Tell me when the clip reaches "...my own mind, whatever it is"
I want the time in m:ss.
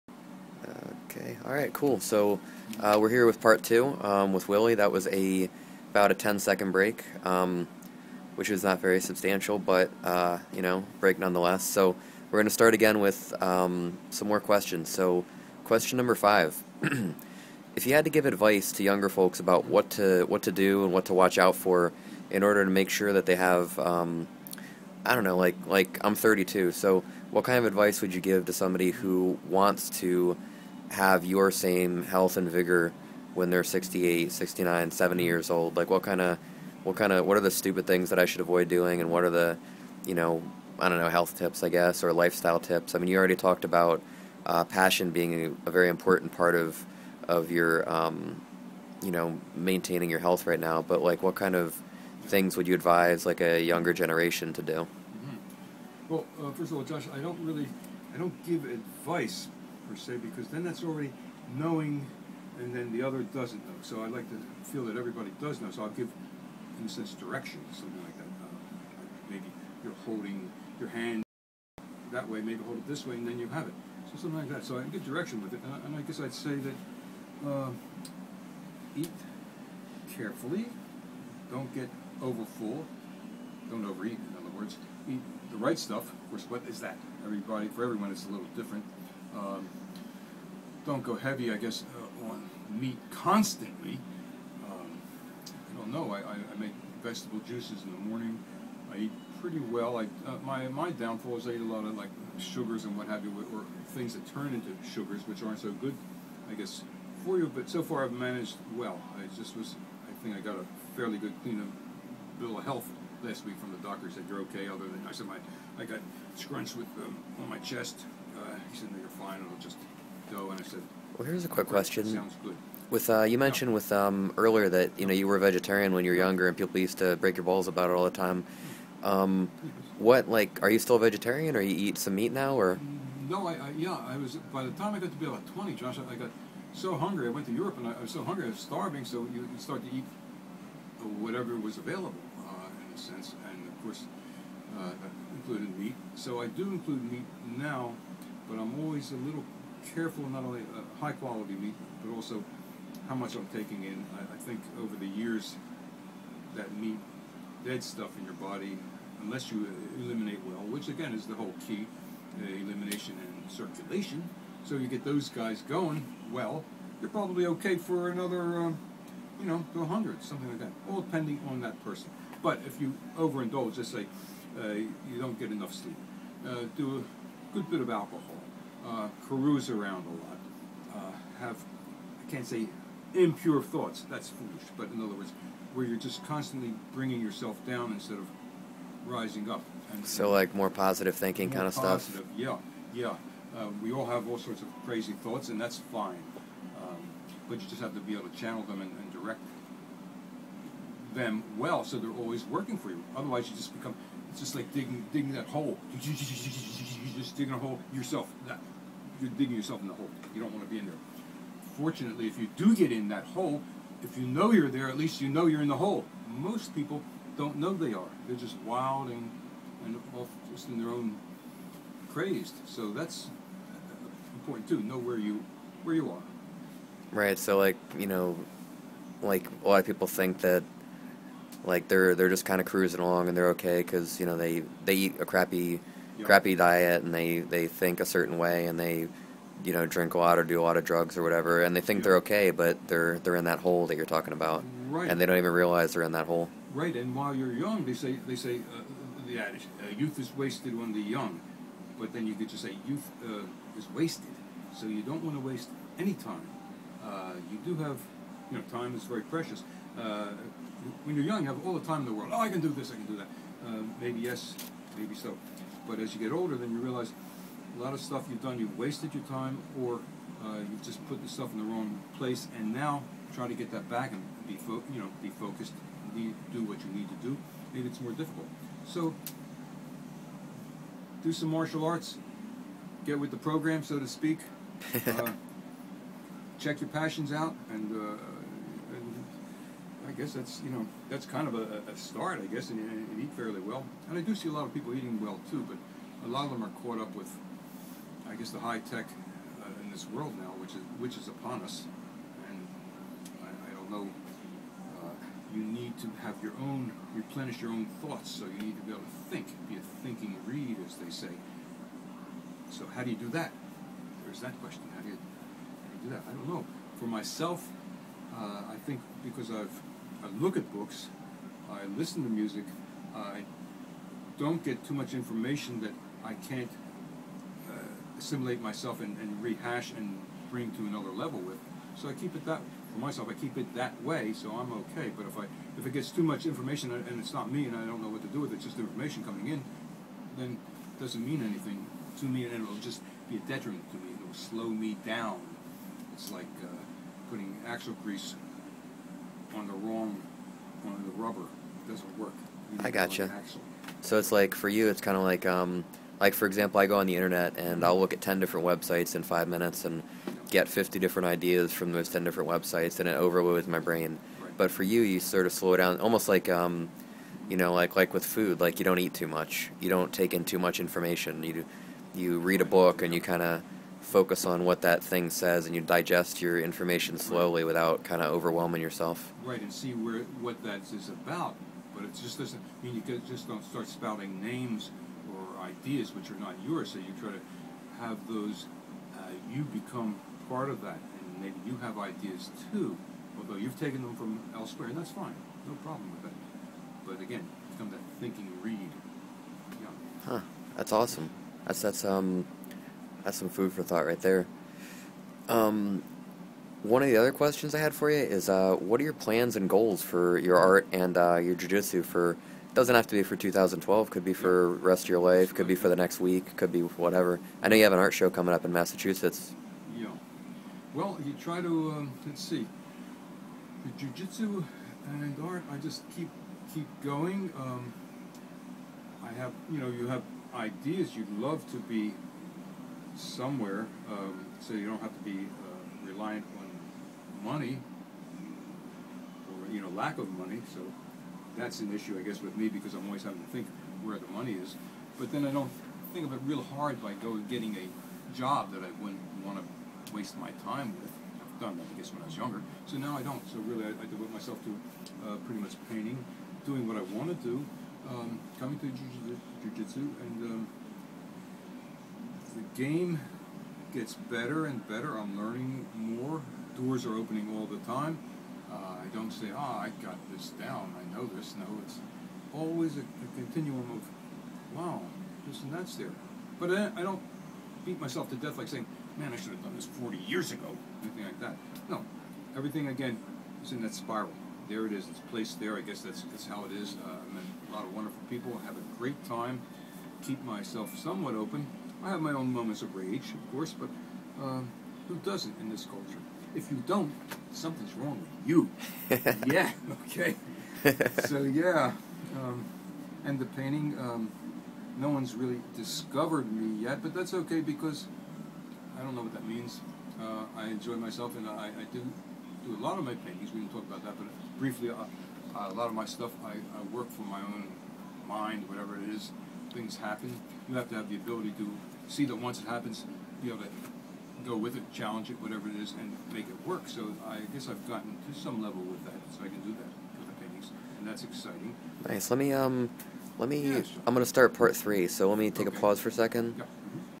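8:37.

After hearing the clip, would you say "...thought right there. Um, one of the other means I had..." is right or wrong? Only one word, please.
wrong.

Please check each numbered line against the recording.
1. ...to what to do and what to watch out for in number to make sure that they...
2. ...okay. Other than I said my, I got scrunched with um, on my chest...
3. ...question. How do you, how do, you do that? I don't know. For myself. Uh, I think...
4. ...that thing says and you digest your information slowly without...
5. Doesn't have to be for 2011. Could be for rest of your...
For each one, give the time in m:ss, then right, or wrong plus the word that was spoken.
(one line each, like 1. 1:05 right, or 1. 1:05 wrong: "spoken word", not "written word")
1. 0:19 wrong: "order", not "number"
2. 1:54 right
3. 5:14 right
4. 6:14 right
5. 6:52 wrong: "2012", not "2011".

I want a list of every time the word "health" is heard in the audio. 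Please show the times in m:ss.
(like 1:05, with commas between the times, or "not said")
0:32, 0:41, 0:50, 1:52.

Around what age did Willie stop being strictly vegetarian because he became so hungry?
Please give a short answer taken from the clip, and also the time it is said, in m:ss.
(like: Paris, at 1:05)
20, at 2:15.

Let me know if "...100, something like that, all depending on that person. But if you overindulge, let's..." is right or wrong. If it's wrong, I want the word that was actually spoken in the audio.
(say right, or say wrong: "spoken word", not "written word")
right.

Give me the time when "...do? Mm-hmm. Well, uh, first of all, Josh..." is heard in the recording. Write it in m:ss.
0:54.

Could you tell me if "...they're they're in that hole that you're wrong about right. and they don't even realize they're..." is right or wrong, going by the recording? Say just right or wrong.
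wrong.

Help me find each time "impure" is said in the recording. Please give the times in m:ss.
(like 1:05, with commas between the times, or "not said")
3:03.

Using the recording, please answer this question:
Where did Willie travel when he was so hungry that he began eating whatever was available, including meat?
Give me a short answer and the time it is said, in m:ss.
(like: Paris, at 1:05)
Europe, at 2:17.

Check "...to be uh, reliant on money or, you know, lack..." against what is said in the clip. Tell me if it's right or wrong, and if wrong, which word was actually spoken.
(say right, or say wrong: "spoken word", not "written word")
right.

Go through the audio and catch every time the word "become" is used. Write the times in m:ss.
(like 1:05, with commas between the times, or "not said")
3:23, 6:29, 6:37.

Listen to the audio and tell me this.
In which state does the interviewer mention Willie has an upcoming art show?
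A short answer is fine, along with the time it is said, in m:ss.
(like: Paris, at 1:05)
Massachusetts, at 6:58.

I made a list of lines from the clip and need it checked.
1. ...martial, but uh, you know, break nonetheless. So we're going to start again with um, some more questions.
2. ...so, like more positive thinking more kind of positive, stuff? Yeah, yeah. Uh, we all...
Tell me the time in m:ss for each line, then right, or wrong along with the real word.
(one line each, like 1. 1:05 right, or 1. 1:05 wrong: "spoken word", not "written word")
1. 0:09 wrong: "substantial", not "martial"
2. 3:10 right.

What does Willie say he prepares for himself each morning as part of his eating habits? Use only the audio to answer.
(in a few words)
vegetable juices.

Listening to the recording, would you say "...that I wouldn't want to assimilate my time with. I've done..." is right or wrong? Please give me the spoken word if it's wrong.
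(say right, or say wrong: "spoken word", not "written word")
wrong: "waste", not "assimilate".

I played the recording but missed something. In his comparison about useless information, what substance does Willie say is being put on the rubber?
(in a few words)
axle grease.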